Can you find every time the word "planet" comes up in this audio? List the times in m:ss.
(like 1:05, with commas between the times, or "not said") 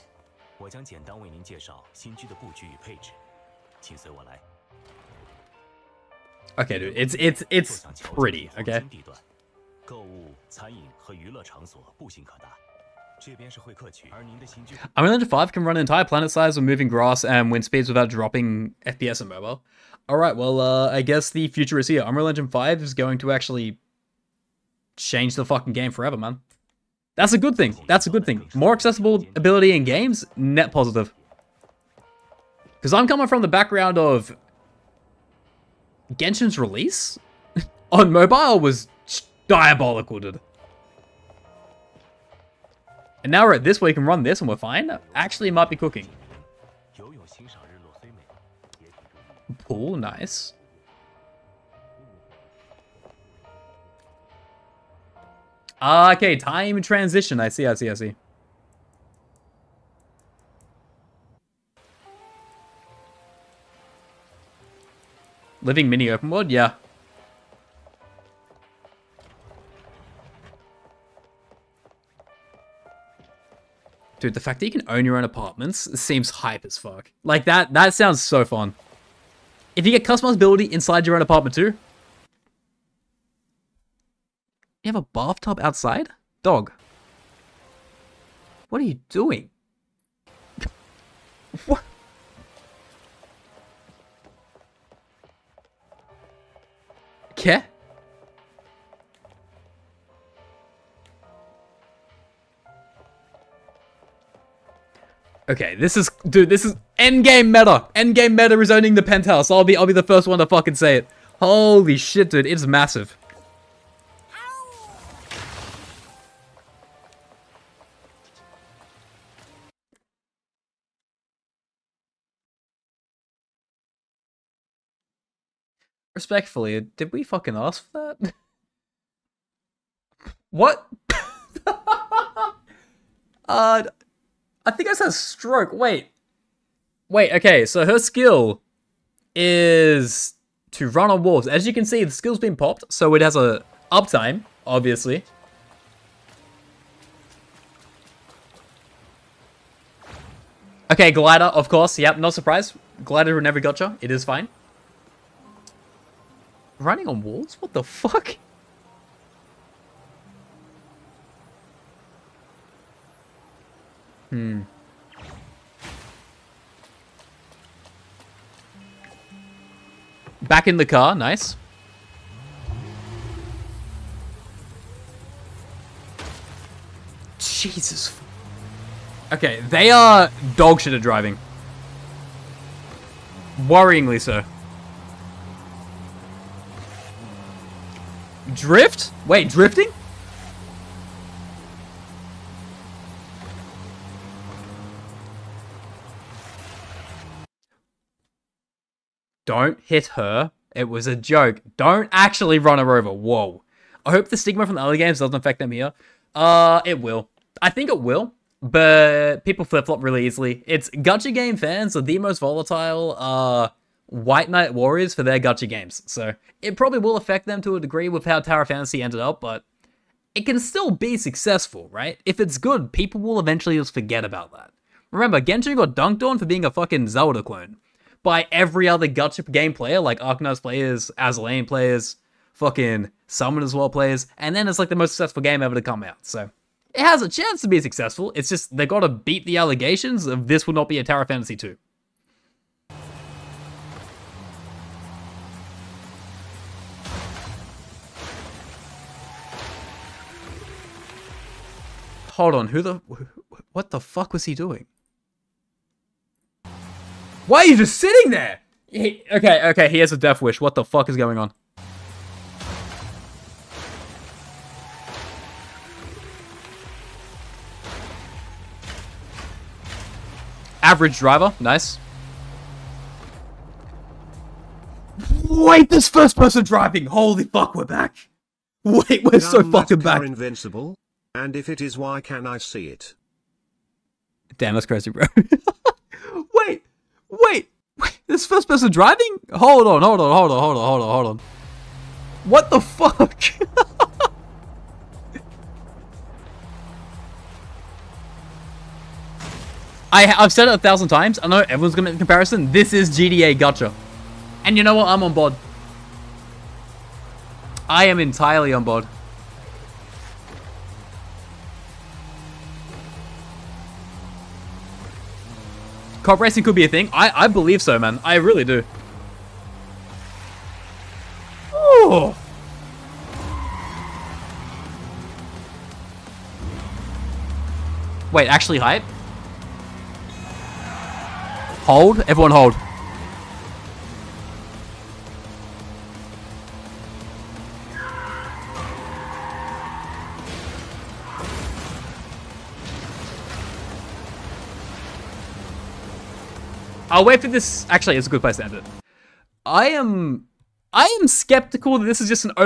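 0:16.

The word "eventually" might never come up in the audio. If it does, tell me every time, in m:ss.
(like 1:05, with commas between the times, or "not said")
3:43.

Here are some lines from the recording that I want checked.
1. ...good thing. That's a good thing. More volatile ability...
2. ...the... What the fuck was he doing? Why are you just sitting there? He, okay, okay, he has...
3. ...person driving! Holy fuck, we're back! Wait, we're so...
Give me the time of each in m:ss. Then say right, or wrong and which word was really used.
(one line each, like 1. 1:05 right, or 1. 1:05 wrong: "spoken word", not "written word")
1. 0:27 wrong: "accessible", not "volatile"
2. 4:12 right
3. 4:36 right.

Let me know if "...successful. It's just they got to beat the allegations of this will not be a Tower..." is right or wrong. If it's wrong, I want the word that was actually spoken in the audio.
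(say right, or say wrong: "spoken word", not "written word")
right.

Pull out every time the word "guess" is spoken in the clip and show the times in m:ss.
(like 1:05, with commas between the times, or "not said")
0:21.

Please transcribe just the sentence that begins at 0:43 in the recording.
And now we're at this where you can run this and we're fine.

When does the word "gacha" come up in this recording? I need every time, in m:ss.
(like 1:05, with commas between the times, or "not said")
2:33, 3:30, 3:35, 3:49, 5:03.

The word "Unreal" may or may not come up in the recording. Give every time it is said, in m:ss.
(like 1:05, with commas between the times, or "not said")
0:14, 0:22.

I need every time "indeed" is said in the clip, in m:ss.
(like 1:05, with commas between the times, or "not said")
not said.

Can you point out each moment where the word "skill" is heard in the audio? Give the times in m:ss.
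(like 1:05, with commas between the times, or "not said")
2:17, 2:22.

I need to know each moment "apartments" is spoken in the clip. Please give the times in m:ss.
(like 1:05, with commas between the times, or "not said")
1:15, 1:21.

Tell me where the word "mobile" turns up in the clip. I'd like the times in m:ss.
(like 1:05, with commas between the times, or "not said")
0:19, 0:38.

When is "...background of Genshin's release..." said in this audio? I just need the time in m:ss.
0:33.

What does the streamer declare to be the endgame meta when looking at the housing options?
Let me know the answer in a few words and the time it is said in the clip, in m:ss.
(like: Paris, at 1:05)
Owning the penthouse, at 1:48.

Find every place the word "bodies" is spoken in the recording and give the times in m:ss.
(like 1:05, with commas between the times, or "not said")
not said.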